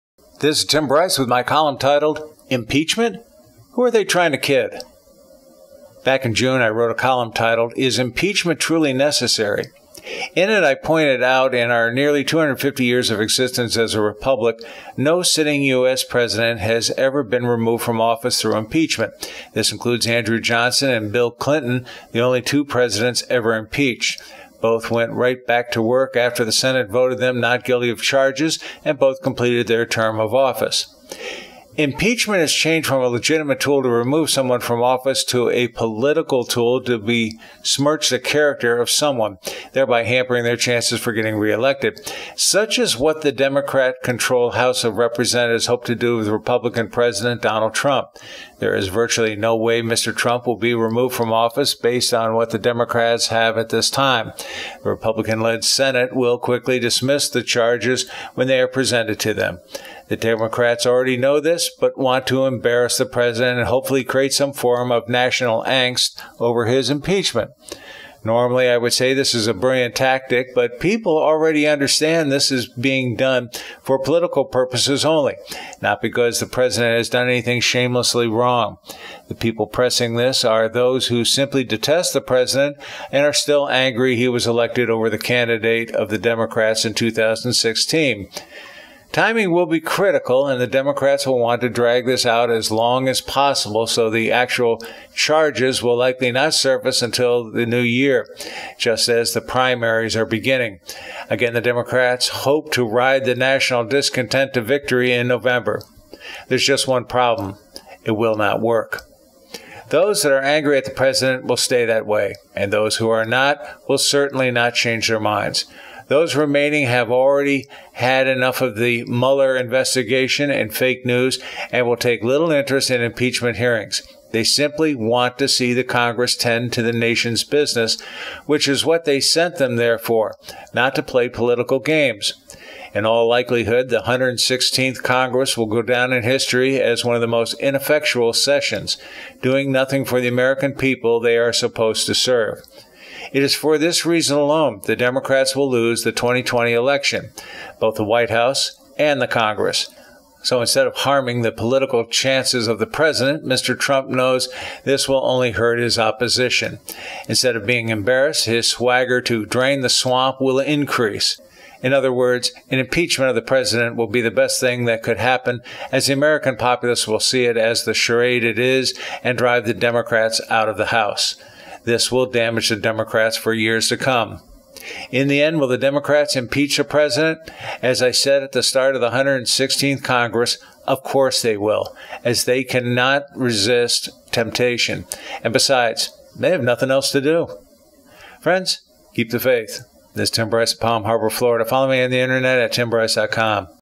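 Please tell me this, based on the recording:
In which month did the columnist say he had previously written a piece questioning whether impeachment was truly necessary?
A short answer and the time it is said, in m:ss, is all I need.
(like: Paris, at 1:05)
June, at 0:06.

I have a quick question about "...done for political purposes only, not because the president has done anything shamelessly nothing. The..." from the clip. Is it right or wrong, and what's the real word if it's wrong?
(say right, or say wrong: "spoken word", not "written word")
wrong: "wrong", not "nothing".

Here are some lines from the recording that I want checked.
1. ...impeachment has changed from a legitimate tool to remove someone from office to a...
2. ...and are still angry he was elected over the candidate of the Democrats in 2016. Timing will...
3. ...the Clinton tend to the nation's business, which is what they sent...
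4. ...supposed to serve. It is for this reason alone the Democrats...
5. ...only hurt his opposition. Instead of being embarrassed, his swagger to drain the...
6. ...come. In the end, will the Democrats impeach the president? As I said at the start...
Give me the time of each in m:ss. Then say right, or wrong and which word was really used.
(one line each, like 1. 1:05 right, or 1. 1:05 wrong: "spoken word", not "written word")
1. 0:31 right
2. 1:23 right
3. 2:05 wrong: "Congress", not "Clinton"
4. 2:21 right
5. 2:35 right
6. 2:53 right.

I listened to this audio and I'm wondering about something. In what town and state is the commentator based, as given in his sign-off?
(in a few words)
Palm Harbor, Florida.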